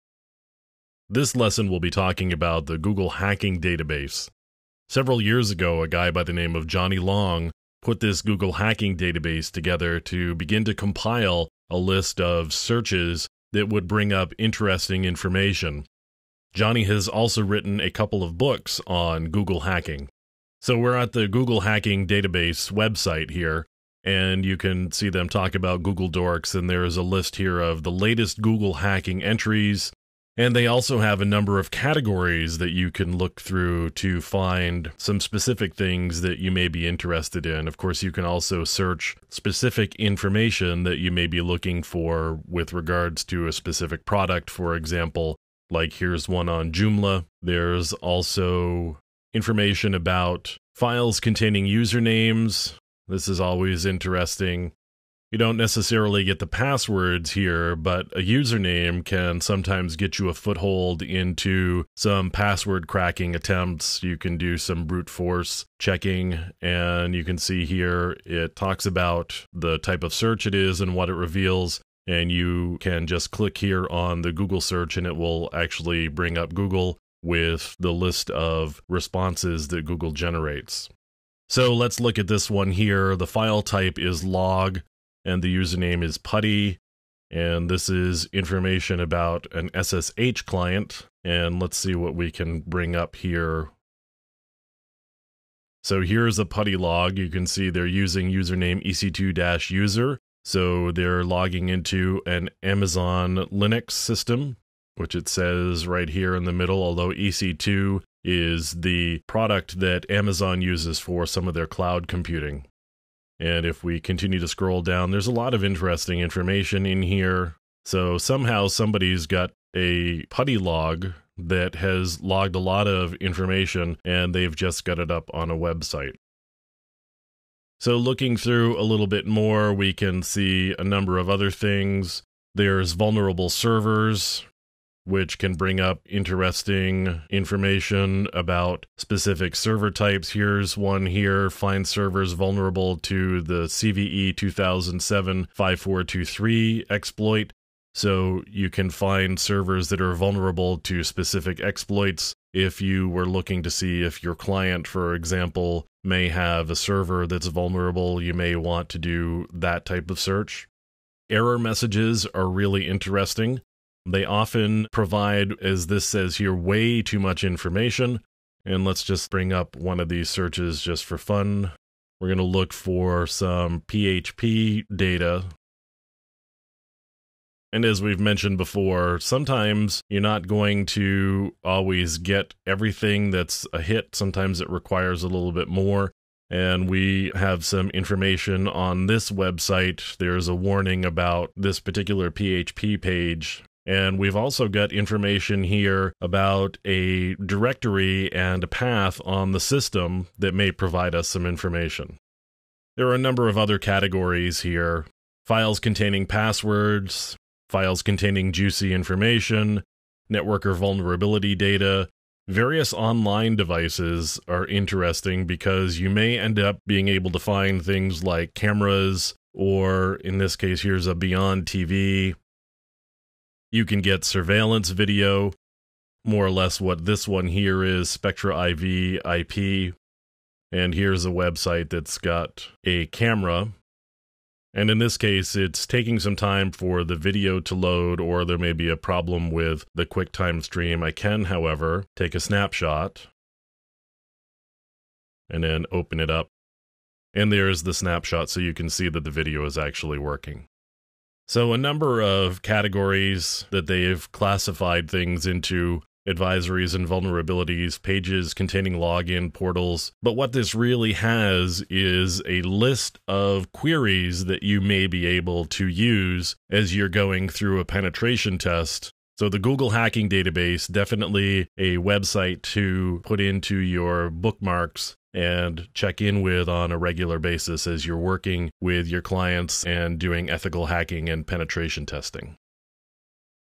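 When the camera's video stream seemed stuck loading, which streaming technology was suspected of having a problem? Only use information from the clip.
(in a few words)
QuickTime.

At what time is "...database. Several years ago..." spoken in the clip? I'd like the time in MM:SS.
00:03.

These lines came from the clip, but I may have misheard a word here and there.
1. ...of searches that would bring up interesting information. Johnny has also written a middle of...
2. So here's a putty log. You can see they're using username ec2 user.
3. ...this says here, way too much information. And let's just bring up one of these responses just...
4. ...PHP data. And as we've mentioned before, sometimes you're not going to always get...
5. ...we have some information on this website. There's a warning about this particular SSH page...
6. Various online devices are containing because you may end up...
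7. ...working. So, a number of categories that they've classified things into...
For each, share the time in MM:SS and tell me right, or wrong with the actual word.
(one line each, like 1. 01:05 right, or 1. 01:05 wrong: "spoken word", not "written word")
1. 00:12 wrong: "couple", not "middle"
2. 01:35 right
3. 02:45 wrong: "searches", not "responses"
4. 02:53 right
5. 03:06 wrong: "PHP", not "SSH"
6. 03:32 wrong: "interesting", not "containing"
7. 04:10 right.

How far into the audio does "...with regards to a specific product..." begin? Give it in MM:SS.
00:42.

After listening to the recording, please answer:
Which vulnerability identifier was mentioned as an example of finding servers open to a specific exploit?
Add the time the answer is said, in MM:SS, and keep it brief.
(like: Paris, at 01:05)
CVE 2007 5423, at 02:23.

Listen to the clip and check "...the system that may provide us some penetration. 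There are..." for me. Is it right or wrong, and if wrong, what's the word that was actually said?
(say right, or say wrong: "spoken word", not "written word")
wrong: "information", not "penetration".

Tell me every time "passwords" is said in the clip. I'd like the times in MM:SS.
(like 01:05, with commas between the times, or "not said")
00:56, 01:02, 03:26.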